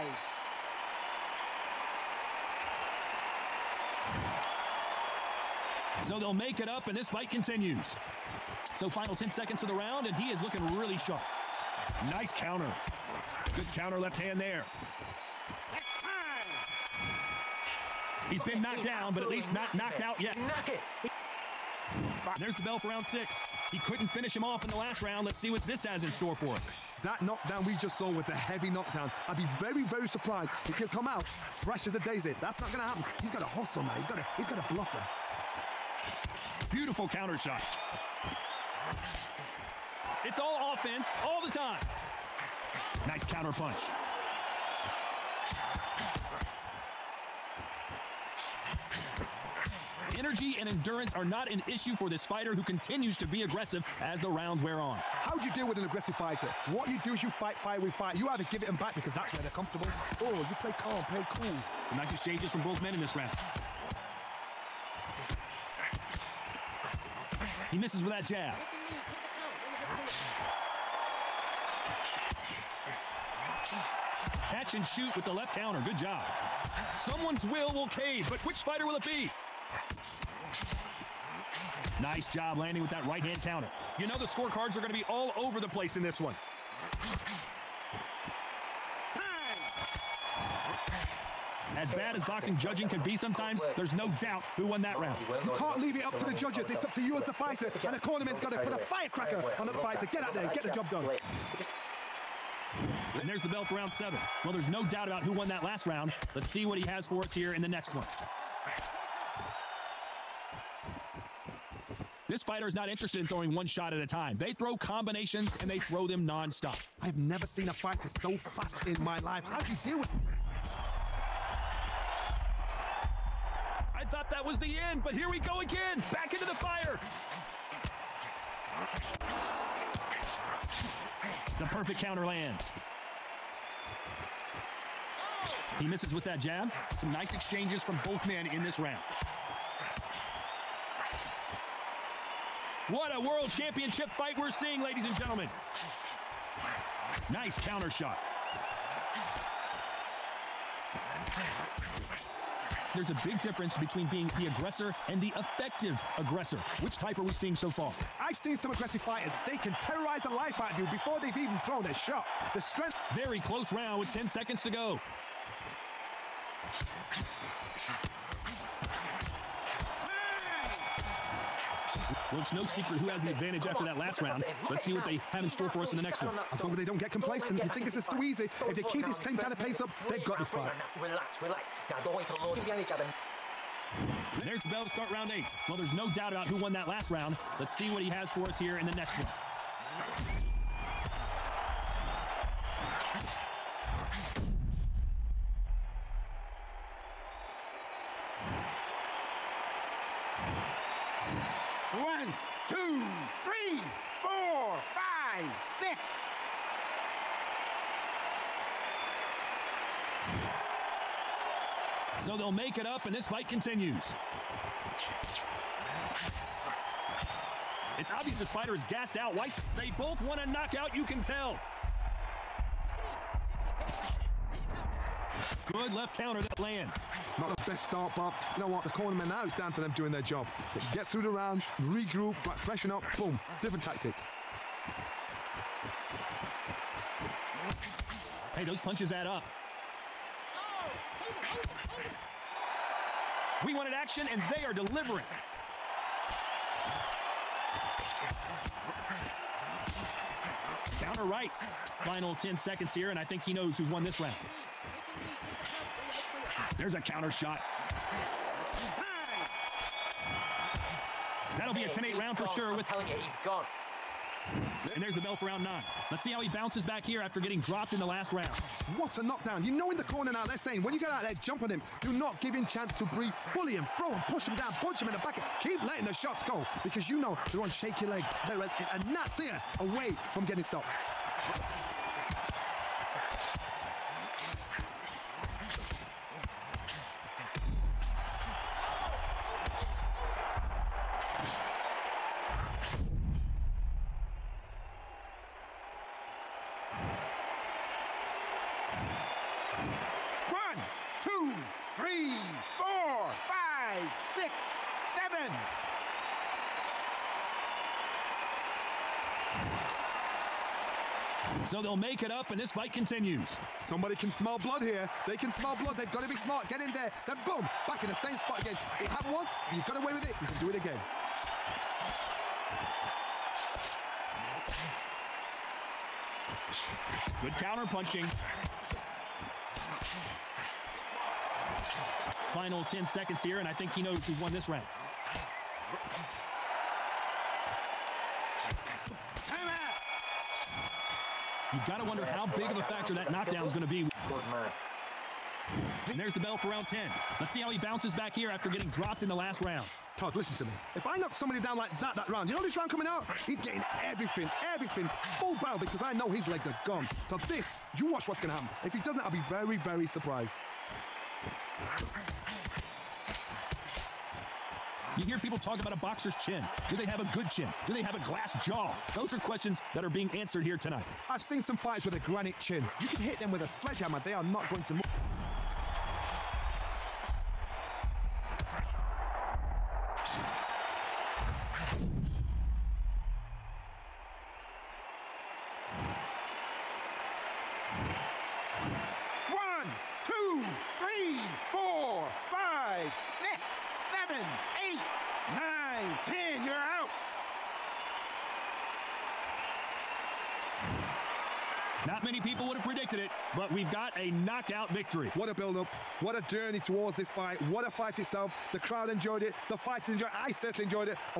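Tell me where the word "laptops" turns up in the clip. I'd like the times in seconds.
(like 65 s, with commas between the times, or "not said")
not said.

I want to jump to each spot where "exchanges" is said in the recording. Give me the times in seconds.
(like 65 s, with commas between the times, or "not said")
62 s, 137 s.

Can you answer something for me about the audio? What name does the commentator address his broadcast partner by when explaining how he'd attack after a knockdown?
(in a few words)
Todd.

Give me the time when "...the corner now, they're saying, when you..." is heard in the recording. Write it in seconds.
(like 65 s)
269 s.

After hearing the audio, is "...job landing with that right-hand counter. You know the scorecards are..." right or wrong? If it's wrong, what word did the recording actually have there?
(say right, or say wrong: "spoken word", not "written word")
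right.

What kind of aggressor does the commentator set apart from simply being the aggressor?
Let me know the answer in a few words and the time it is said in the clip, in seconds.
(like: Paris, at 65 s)
effective aggressor, at 155 s.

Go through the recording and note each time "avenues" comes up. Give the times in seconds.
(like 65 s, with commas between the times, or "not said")
not said.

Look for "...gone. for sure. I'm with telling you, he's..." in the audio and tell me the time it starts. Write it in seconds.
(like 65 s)
262 s.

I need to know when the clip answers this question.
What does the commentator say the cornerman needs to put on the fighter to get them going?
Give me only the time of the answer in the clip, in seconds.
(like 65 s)
98 s.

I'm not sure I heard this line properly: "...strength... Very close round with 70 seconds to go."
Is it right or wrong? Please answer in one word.
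wrong.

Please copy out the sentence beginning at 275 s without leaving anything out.
Keep letting the shots go because you know they're on shaky leg.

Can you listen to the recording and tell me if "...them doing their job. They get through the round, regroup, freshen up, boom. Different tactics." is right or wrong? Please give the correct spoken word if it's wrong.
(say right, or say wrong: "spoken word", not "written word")
right.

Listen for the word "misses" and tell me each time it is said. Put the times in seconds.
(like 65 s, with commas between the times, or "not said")
67 s, 135 s.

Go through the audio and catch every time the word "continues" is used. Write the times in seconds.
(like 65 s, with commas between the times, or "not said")
7 s, 52 s, 213 s, 312 s.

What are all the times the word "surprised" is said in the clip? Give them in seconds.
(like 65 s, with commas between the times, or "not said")
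30 s, 360 s.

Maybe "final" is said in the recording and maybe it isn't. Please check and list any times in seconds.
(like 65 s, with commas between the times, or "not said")
8 s, 252 s, 332 s.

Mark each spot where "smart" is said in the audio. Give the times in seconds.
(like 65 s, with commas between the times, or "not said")
316 s.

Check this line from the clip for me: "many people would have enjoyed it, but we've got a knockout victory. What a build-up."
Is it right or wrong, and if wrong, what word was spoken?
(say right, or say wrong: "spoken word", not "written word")
wrong: "predicted", not "enjoyed".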